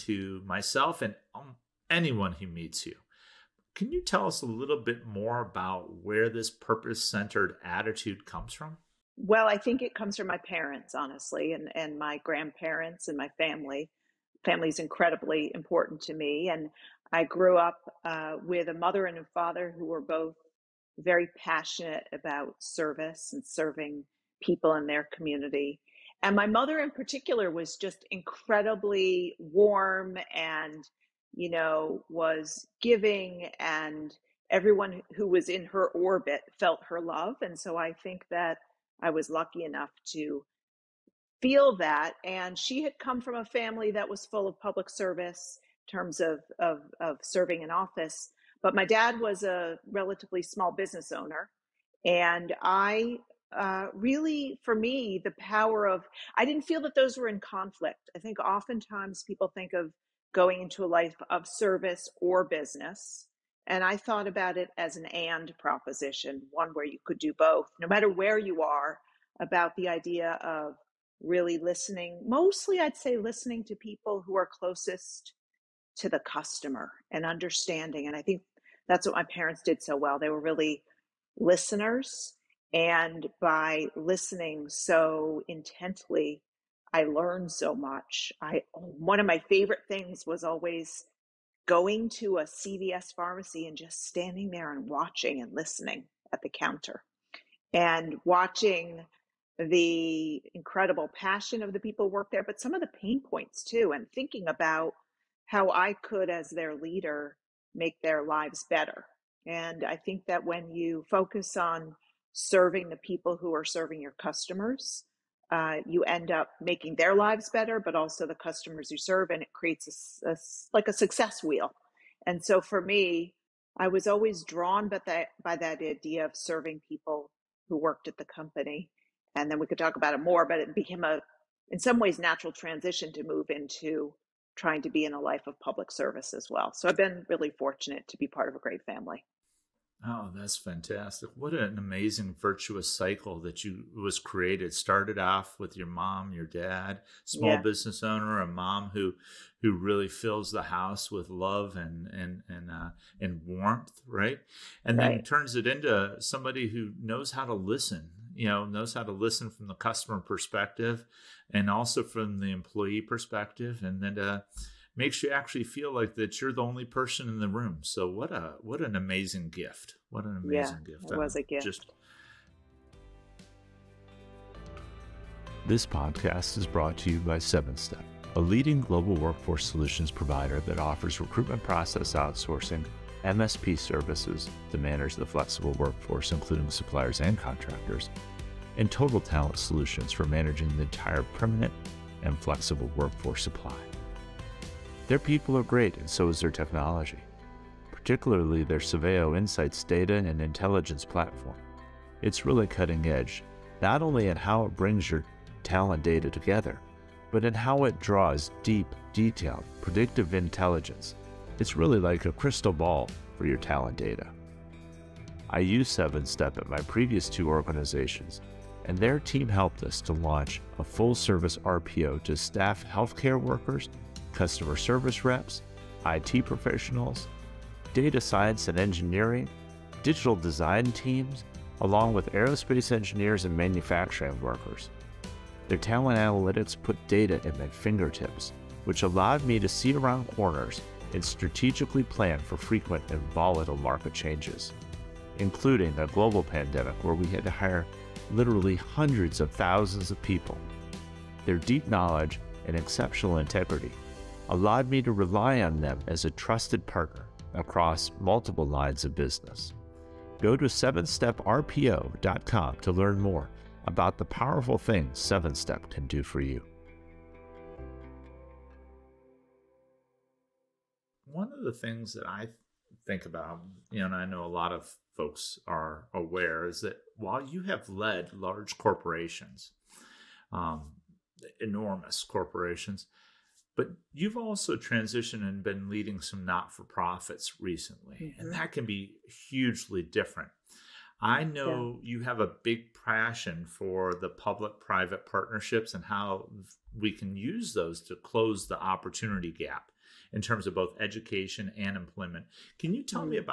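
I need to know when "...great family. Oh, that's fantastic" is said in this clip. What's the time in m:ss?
2:18.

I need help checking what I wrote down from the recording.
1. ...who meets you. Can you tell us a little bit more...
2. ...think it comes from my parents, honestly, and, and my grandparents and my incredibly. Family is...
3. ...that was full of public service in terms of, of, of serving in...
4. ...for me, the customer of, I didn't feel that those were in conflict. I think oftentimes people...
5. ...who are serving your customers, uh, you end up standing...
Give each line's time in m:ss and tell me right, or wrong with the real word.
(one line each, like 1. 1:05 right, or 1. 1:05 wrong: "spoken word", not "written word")
1. 0:02 right
2. 0:09 wrong: "family", not "incredibly"
3. 0:43 right
4. 0:54 wrong: "power", not "customer"
5. 1:53 wrong: "making", not "standing".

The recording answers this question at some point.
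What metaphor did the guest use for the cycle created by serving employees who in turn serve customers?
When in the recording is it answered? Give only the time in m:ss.
2:00.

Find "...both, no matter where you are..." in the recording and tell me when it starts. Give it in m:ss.
1:07.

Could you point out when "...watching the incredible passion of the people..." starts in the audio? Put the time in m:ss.
1:38.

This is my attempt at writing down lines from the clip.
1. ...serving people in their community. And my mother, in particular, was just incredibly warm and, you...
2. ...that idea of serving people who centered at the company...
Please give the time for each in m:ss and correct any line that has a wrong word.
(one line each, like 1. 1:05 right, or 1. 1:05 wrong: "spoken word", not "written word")
1. 0:23 right
2. 2:05 wrong: "worked", not "centered".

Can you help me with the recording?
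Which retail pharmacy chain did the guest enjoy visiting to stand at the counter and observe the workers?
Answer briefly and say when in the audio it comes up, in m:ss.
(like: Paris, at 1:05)
CVS, at 1:32.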